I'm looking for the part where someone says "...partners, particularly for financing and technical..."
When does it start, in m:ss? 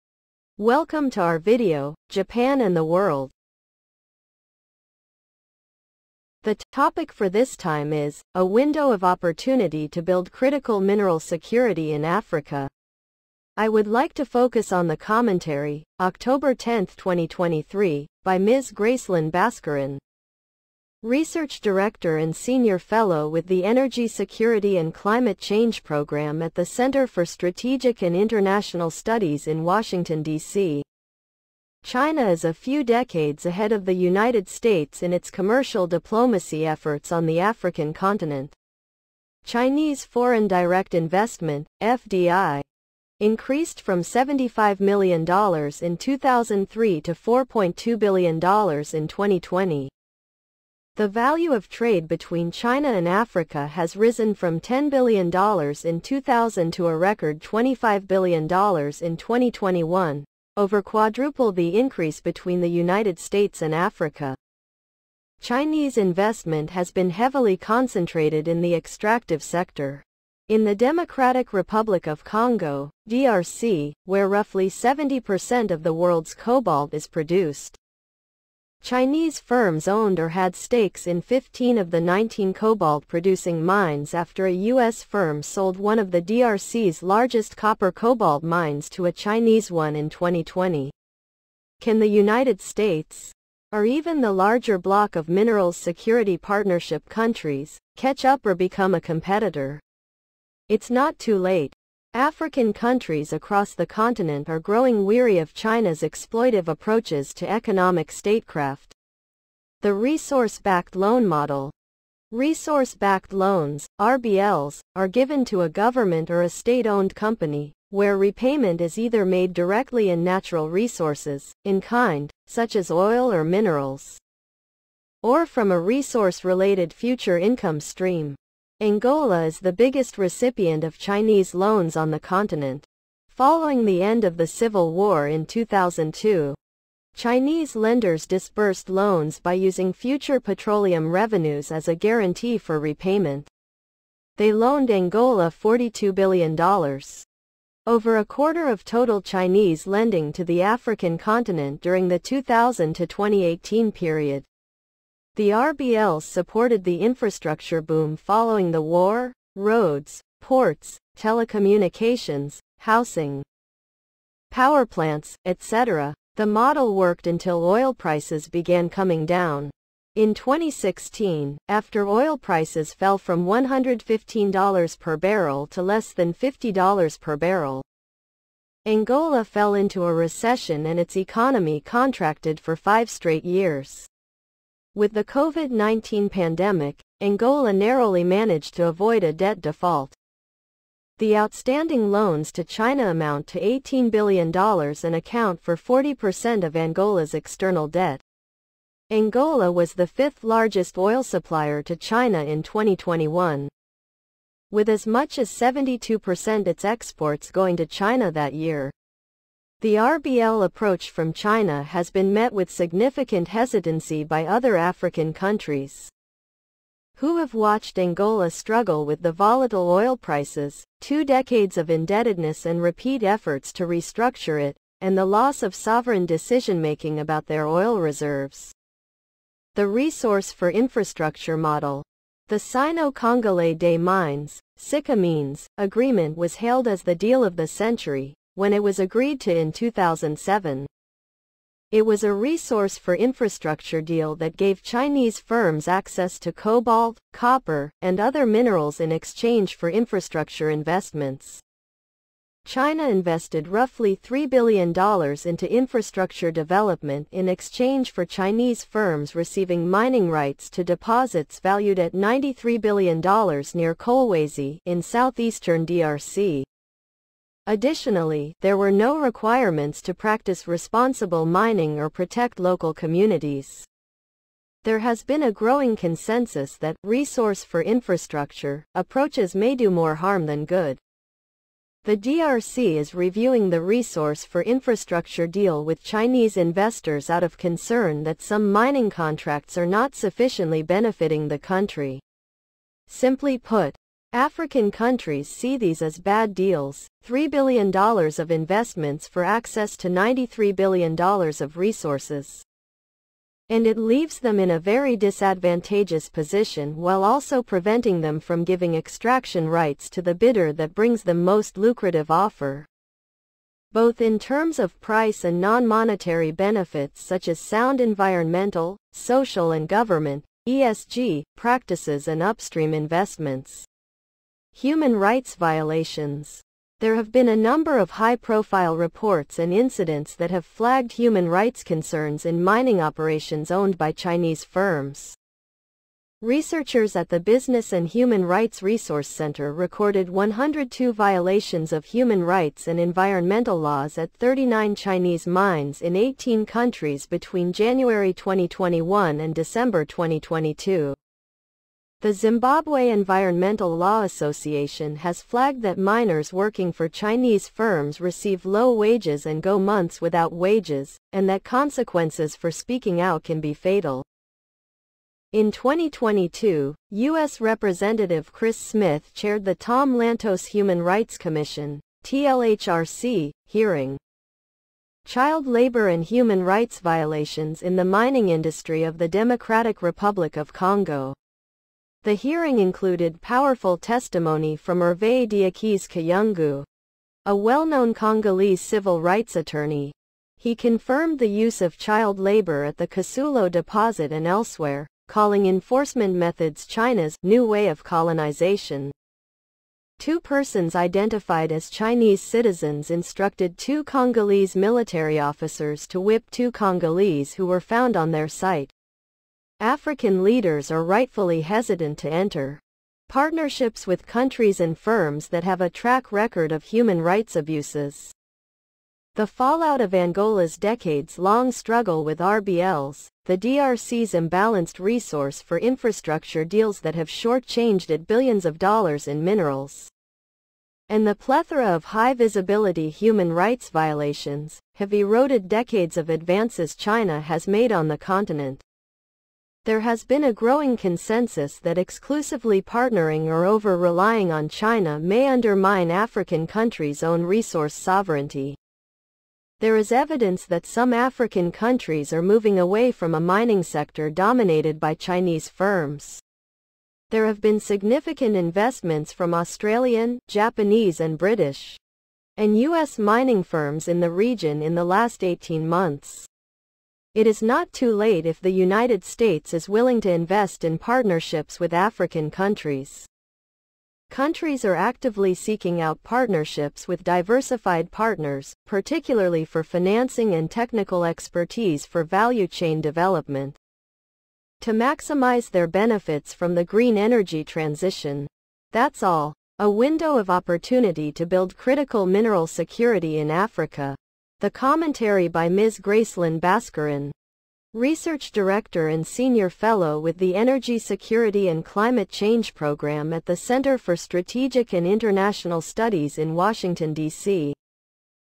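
7:58.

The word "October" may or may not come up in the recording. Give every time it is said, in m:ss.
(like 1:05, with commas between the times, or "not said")
0:15.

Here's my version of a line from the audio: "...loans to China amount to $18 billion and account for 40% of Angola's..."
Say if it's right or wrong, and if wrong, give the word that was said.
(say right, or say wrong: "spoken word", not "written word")
right.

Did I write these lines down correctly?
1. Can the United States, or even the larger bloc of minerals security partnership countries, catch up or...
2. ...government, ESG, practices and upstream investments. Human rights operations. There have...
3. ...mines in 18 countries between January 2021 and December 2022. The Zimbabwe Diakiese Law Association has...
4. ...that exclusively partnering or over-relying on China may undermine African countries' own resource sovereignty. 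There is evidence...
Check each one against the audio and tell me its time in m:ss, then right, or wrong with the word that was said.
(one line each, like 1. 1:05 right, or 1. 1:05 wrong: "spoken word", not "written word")
1. 1:31 right
2. 5:19 wrong: "violations", not "operations"
3. 5:45 wrong: "Environmental", not "Diakiese"
4. 7:21 right.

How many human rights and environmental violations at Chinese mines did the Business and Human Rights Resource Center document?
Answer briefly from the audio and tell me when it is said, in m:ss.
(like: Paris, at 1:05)
102, at 5:40.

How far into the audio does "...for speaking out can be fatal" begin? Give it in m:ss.
6:02.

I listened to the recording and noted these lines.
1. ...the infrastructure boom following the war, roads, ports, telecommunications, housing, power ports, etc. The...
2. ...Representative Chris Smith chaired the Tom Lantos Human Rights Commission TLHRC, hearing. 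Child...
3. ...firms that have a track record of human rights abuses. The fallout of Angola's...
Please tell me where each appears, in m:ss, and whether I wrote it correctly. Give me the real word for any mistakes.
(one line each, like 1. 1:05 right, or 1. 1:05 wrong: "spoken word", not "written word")
1. 2:36 wrong: "plants", not "ports"
2. 6:07 right
3. 6:54 right.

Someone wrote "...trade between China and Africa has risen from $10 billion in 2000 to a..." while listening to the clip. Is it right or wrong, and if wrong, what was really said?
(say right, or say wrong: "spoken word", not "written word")
right.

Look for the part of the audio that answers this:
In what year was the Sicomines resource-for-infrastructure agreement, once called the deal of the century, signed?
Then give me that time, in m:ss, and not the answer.
3:59.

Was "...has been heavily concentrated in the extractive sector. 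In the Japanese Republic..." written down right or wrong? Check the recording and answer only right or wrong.
wrong.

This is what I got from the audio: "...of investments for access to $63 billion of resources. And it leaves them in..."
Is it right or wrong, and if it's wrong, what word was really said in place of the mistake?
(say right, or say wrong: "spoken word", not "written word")
wrong: "93", not "63".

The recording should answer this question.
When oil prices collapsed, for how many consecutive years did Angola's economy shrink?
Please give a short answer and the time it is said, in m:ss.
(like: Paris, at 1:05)
5, at 3:02.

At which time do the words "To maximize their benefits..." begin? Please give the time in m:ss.
8:04.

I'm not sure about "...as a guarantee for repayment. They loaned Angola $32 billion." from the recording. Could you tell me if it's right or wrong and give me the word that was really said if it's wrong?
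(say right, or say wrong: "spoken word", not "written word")
wrong: "42", not "32".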